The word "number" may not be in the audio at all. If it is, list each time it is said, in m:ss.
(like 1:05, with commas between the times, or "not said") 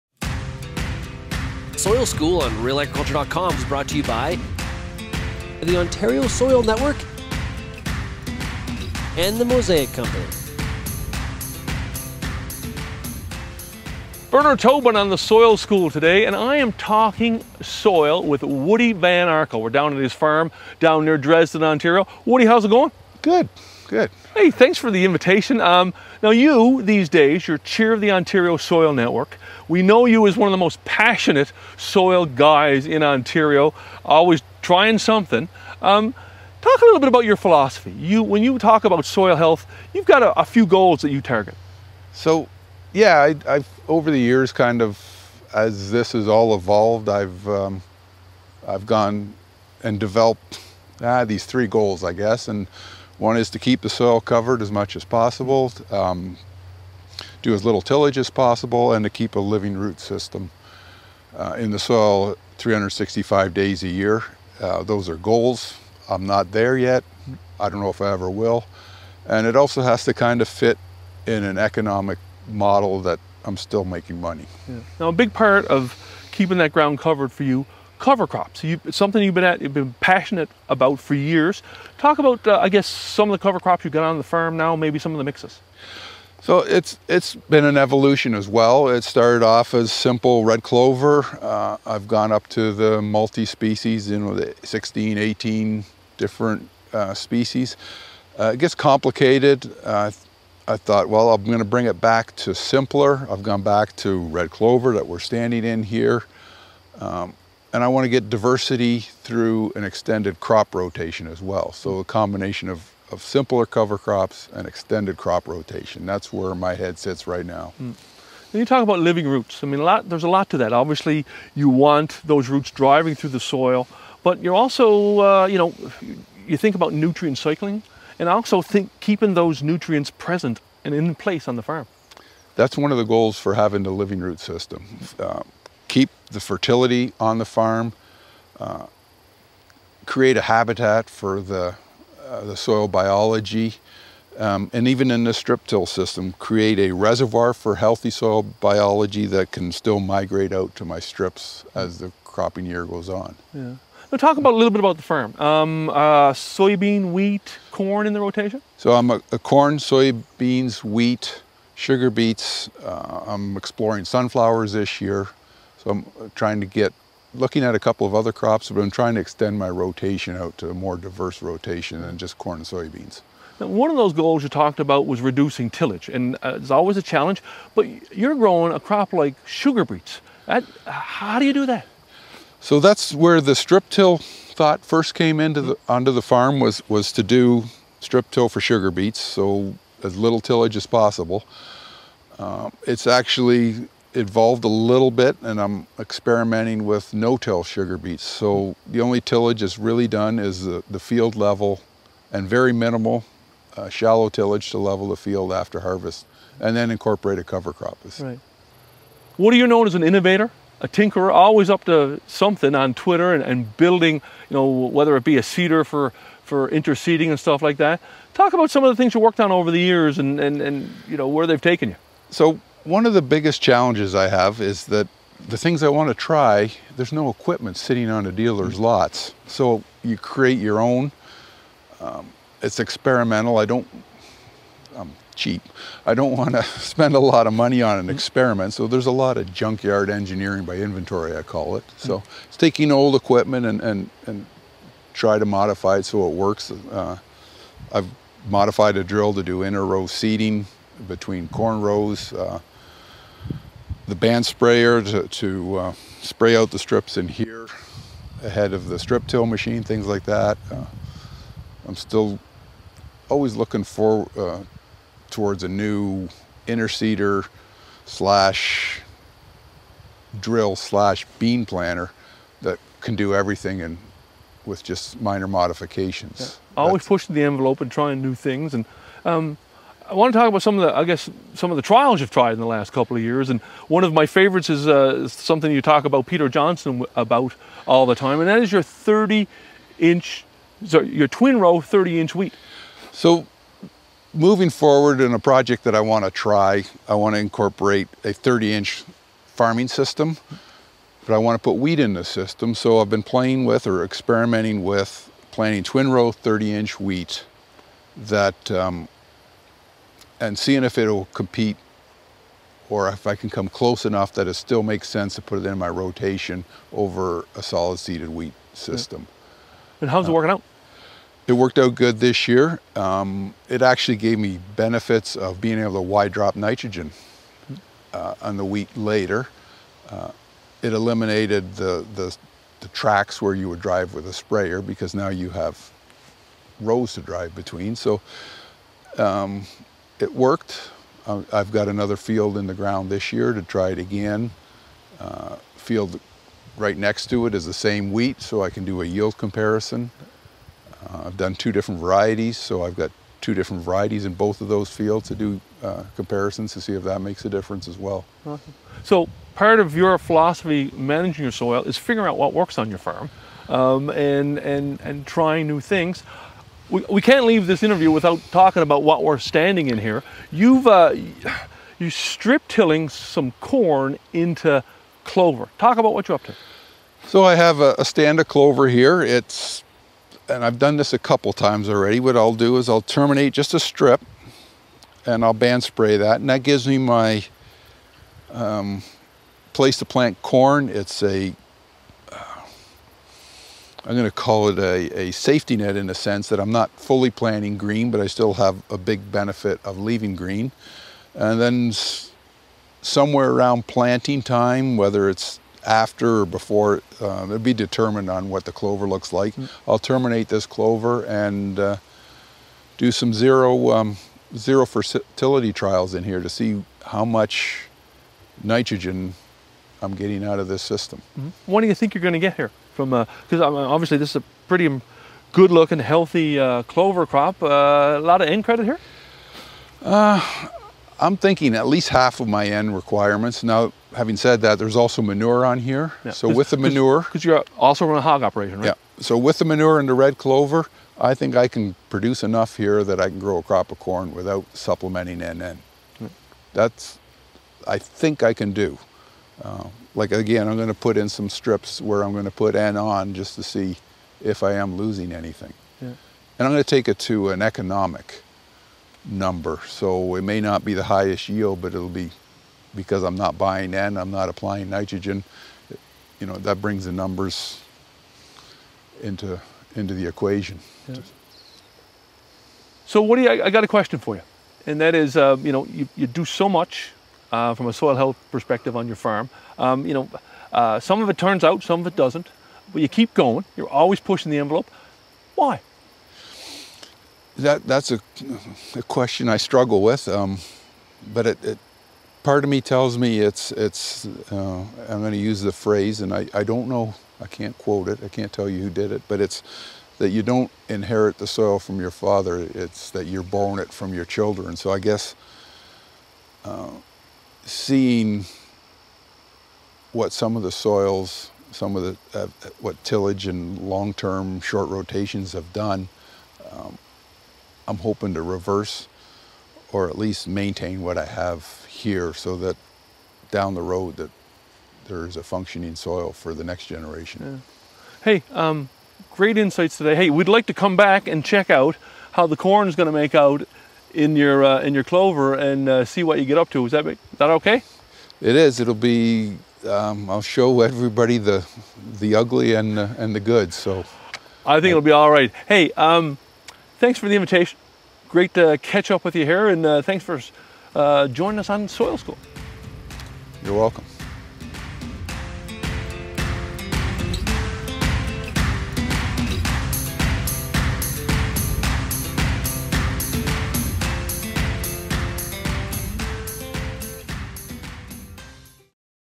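7:39, 7:47.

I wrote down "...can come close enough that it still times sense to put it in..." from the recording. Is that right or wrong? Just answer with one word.
wrong.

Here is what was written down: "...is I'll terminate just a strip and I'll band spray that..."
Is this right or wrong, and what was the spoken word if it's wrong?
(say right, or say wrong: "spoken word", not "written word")
right.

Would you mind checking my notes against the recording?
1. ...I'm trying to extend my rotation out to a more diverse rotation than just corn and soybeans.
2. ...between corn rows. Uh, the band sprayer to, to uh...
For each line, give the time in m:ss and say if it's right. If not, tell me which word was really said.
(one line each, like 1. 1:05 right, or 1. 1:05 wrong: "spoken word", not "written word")
1. 2:48 right
2. 4:11 right.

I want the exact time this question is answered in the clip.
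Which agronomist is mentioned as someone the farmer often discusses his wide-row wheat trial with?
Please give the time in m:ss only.
4:46.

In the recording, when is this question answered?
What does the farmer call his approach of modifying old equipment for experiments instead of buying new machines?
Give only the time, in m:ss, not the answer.
3:59.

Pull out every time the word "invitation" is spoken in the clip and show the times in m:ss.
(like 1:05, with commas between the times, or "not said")
0:25, 9:07.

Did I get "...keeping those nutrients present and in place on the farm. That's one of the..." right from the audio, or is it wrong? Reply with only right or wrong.
right.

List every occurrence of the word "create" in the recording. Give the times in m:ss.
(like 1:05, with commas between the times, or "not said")
2:20, 2:26, 3:50.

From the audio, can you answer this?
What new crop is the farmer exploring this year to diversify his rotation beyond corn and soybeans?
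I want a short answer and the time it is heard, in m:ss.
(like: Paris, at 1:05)
Sunflowers, at 2:44.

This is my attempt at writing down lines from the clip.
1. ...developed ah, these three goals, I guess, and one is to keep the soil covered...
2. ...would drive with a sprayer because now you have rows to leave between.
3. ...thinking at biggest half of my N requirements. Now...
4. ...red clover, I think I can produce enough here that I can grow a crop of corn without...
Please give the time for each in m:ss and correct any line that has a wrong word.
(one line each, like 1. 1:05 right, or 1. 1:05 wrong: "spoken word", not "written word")
1. 0:49 right
2. 5:33 wrong: "drive", not "leave"
3. 7:11 wrong: "least", not "biggest"
4. 7:20 right.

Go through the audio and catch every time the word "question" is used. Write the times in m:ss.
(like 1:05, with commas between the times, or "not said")
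7:53, 8:09.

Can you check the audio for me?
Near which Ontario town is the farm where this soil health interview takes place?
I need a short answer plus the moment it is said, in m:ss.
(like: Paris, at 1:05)
Dresden, at 0:21.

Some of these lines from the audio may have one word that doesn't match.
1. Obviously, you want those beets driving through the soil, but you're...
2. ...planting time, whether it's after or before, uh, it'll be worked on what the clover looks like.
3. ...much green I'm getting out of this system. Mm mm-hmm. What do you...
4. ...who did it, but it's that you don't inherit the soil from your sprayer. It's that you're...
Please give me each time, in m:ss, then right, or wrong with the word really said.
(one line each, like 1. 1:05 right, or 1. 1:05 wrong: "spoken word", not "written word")
1. 2:00 wrong: "roots", not "beets"
2. 6:43 wrong: "determined", not "worked"
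3. 6:57 wrong: "nitrogen", not "green"
4. 8:18 wrong: "father", not "sprayer".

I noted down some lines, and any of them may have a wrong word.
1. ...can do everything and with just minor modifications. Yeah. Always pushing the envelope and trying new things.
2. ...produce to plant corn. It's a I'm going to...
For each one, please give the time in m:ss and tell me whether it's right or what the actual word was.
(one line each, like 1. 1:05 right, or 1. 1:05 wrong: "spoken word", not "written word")
1. 4:32 right
2. 6:29 wrong: "place", not "produce".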